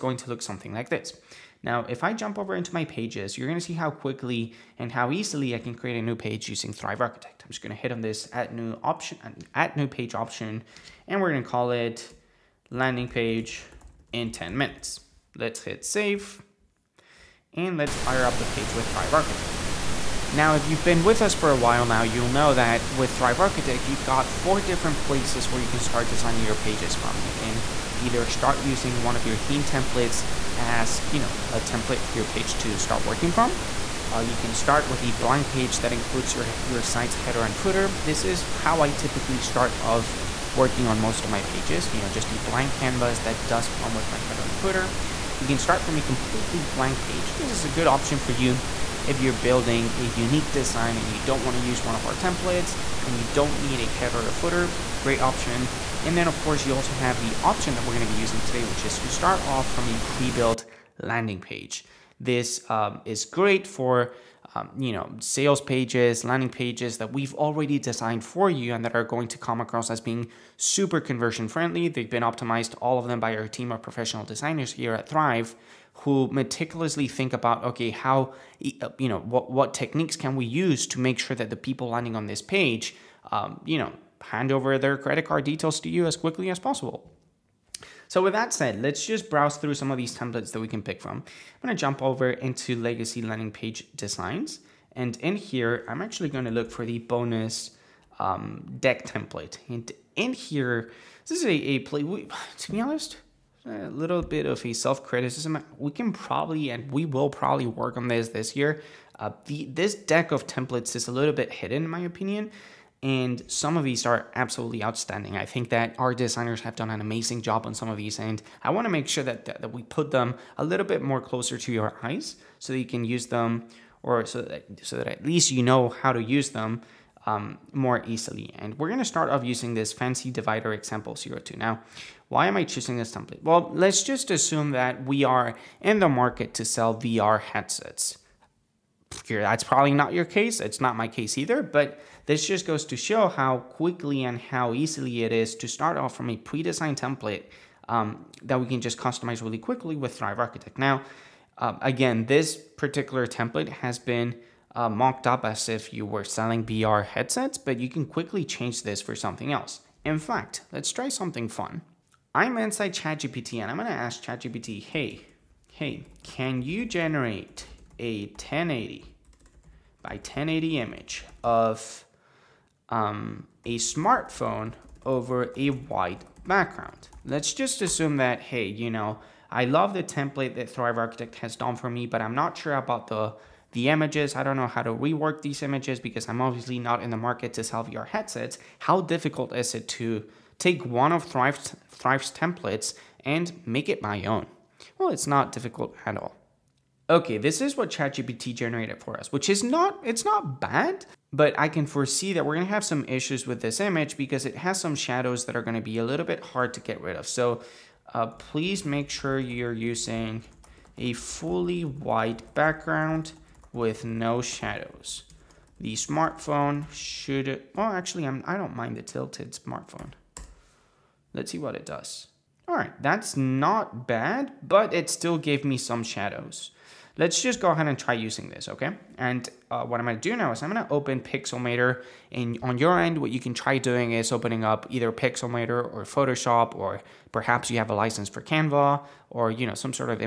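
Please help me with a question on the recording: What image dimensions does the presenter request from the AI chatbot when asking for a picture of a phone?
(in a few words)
1080 by 1080.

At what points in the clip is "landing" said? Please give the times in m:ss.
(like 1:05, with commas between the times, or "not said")
0:12, 1:01, 1:06, 1:21, 1:33.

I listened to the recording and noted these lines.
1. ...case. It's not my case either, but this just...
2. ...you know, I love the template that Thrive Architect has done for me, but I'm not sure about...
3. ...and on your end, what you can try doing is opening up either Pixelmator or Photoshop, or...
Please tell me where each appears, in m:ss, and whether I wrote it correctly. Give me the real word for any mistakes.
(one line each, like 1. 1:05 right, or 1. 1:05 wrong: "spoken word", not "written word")
1. 2:20 right
2. 2:58 right
3. 3:52 right.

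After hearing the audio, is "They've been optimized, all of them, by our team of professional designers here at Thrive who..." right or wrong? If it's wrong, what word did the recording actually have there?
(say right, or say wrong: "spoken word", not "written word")
right.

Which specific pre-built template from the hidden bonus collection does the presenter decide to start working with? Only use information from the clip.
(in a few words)
Fancy divider example 02.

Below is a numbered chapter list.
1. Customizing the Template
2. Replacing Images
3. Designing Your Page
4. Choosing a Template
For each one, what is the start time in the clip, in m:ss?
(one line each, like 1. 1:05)
1. 2:10
2. 2:31
3. 0:19
4. 0:55.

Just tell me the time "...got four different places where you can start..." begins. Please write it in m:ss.
0:24.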